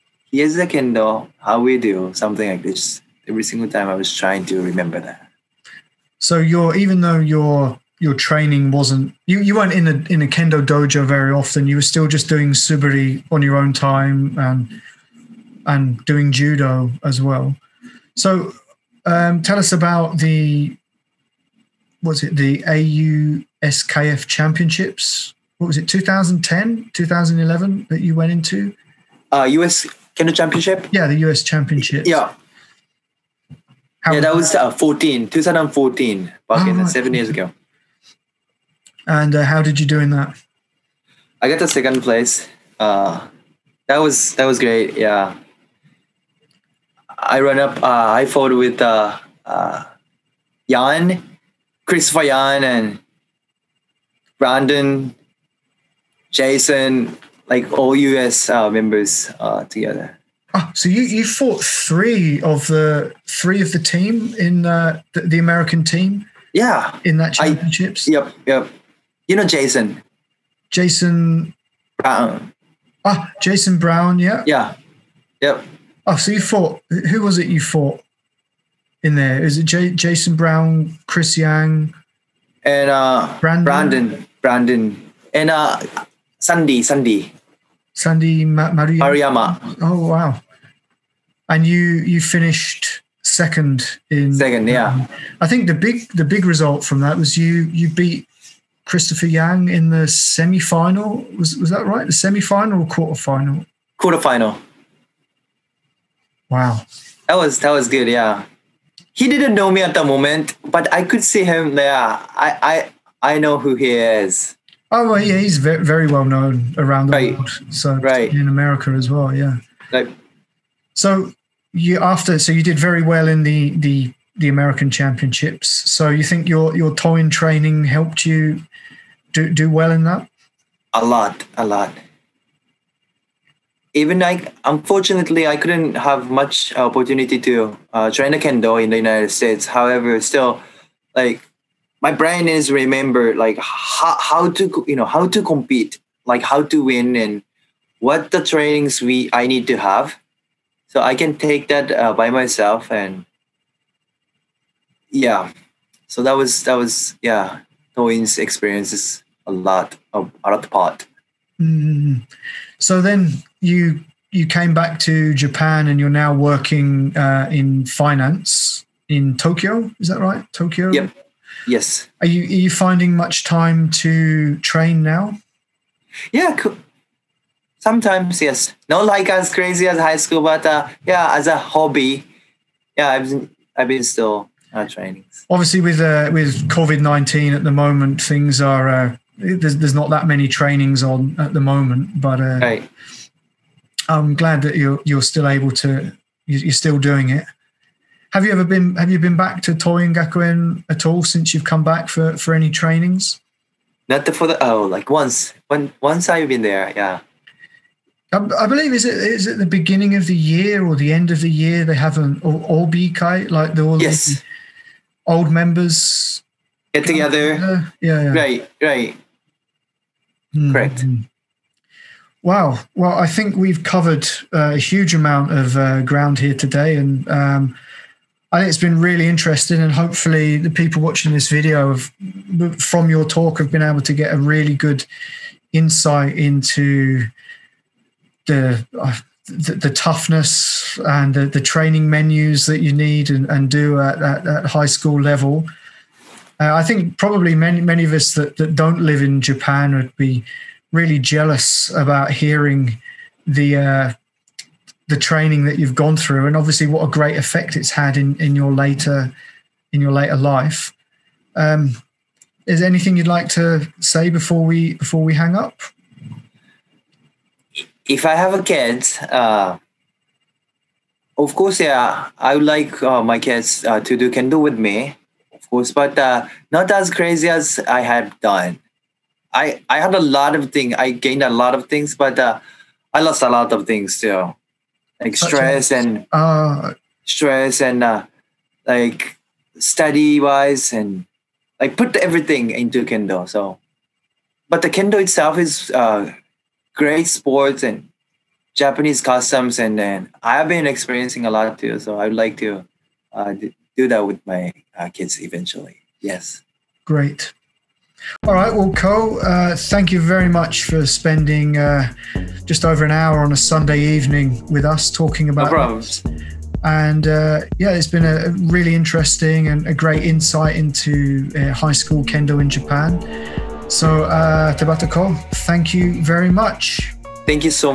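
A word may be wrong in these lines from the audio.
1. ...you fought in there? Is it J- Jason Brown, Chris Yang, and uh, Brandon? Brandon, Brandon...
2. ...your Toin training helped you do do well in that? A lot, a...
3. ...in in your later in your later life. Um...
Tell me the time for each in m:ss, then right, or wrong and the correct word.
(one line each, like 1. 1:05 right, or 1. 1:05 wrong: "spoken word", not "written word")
1. 1:17 right
2. 2:06 right
3. 4:18 right.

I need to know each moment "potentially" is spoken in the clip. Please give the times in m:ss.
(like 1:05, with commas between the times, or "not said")
not said.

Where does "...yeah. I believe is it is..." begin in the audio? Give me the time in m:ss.
3:26.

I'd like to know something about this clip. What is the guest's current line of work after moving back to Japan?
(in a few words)
Finance.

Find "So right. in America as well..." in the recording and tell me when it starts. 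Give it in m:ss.
1:57.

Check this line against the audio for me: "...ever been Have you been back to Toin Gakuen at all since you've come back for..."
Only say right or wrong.
right.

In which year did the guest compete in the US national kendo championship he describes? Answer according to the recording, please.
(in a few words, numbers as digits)
2014.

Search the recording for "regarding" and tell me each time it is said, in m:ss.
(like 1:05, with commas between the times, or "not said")
not said.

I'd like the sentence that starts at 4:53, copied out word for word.
So, but the kendo itself is great sports and Japanese customs, and then I've been experiencing a lot too.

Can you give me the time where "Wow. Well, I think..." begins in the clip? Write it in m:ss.
3:42.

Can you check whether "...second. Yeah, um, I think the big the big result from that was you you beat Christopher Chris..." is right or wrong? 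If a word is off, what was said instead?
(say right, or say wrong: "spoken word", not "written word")
wrong: "Yang", not "Chris".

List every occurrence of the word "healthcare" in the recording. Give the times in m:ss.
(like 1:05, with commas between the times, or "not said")
not said.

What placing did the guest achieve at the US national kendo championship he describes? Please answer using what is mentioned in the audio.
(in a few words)
Second place.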